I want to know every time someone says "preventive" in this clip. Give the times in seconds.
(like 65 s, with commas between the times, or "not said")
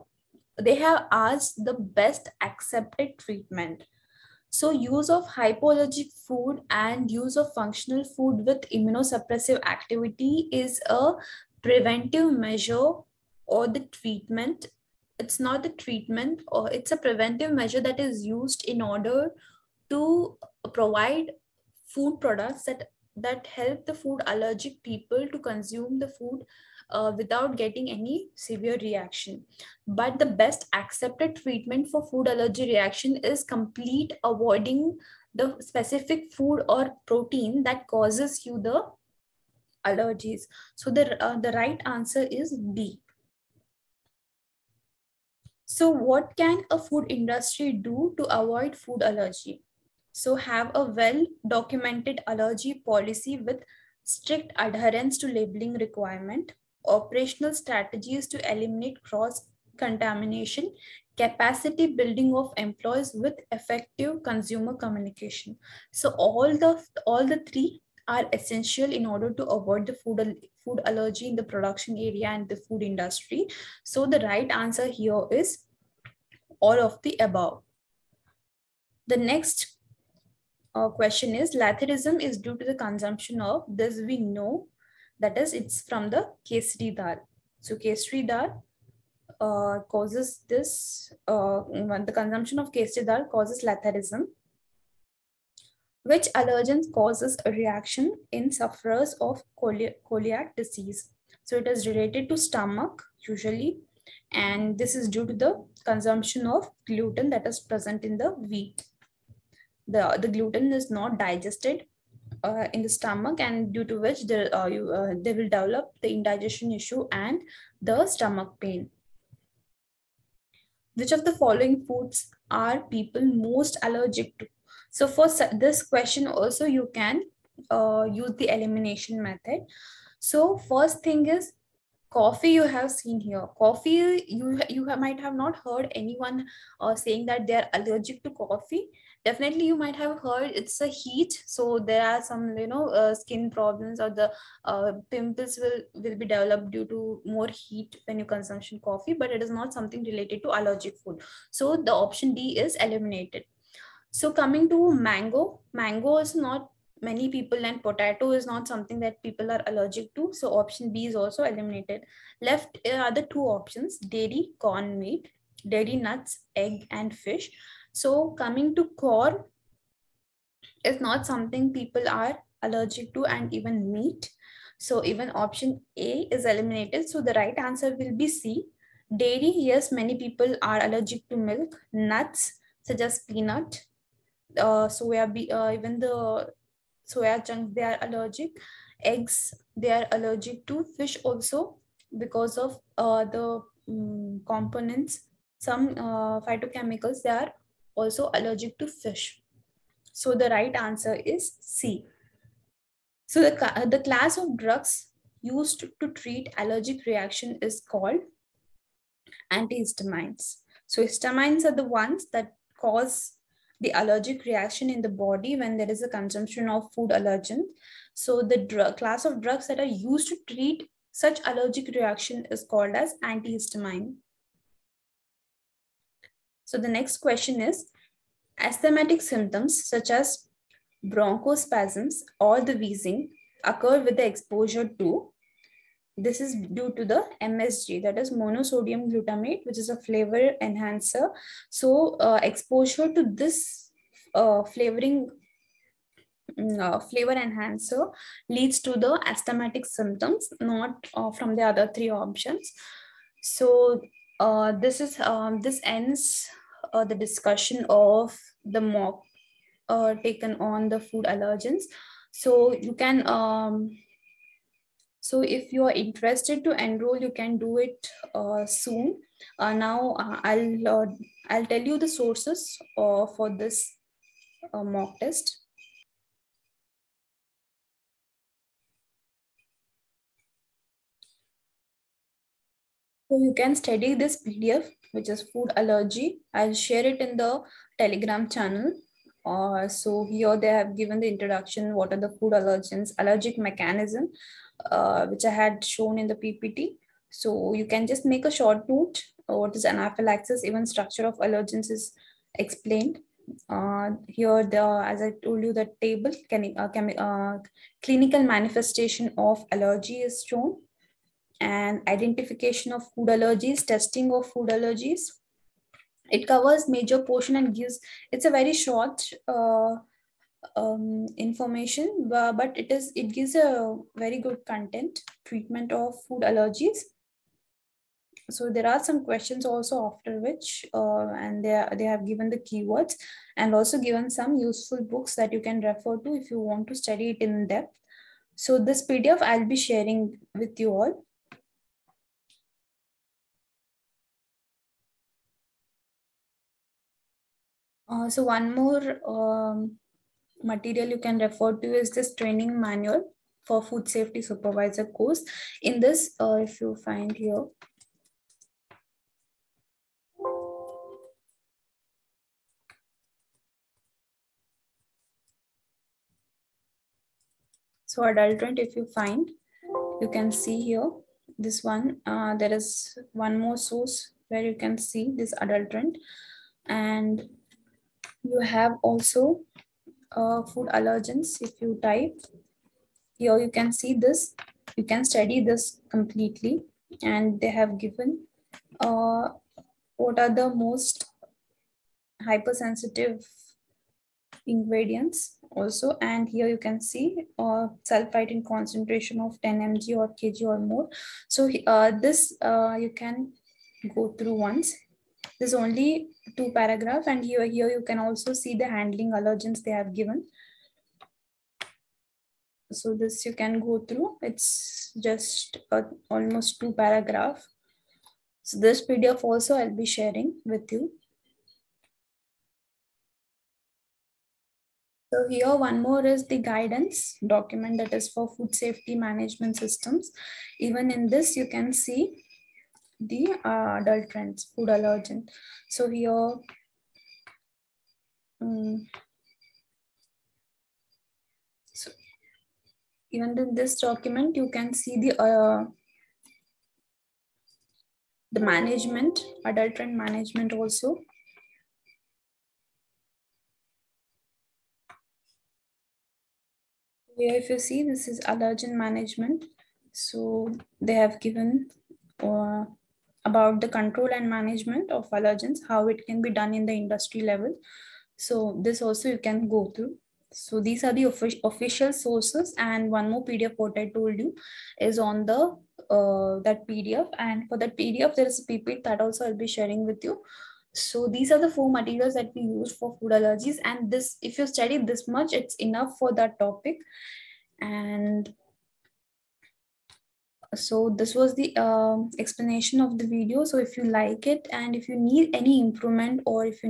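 11 s, 17 s.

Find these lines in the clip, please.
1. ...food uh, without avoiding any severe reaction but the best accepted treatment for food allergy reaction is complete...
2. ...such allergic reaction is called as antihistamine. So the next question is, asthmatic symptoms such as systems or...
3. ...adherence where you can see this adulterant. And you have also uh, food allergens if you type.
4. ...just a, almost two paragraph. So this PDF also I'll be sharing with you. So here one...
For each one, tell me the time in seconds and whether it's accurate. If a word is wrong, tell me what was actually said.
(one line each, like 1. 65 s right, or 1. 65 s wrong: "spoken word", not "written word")
1. 26 s wrong: "getting", not "avoiding"
2. 221 s wrong: "bronchospasms", not "systems"
3. 373 s wrong: "source", not "adherence"
4. 415 s right.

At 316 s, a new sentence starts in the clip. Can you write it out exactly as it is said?
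It covers major portion and gives.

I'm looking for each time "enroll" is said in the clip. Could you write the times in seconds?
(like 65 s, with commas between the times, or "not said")
266 s.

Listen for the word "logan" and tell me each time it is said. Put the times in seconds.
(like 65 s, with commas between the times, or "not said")
not said.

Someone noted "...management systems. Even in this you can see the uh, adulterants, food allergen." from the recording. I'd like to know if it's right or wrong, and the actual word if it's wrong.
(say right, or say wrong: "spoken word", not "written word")
right.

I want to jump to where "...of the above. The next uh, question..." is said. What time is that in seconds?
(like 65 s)
76 s.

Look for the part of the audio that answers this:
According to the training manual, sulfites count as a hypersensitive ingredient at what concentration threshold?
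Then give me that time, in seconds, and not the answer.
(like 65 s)
399 s.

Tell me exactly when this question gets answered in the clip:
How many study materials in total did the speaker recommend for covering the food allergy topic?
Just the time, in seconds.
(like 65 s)
481 s.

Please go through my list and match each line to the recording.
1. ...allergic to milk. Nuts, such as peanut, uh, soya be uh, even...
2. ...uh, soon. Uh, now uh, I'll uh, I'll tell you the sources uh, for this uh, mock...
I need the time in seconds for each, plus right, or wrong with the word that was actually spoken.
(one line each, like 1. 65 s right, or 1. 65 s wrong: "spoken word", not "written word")
1. 180 s right
2. 268 s right.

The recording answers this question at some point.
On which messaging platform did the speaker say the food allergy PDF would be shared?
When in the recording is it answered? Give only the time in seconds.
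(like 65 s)
287 s.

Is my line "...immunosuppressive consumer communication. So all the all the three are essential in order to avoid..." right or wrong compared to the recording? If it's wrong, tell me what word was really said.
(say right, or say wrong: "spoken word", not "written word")
wrong: "effective", not "immunosuppressive".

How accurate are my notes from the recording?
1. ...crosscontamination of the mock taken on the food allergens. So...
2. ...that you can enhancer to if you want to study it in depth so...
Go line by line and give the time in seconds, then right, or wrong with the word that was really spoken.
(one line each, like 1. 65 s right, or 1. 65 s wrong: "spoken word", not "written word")
1. 257 s wrong: "discussion", not "crosscontamination"
2. 335 s wrong: "refer", not "enhancer".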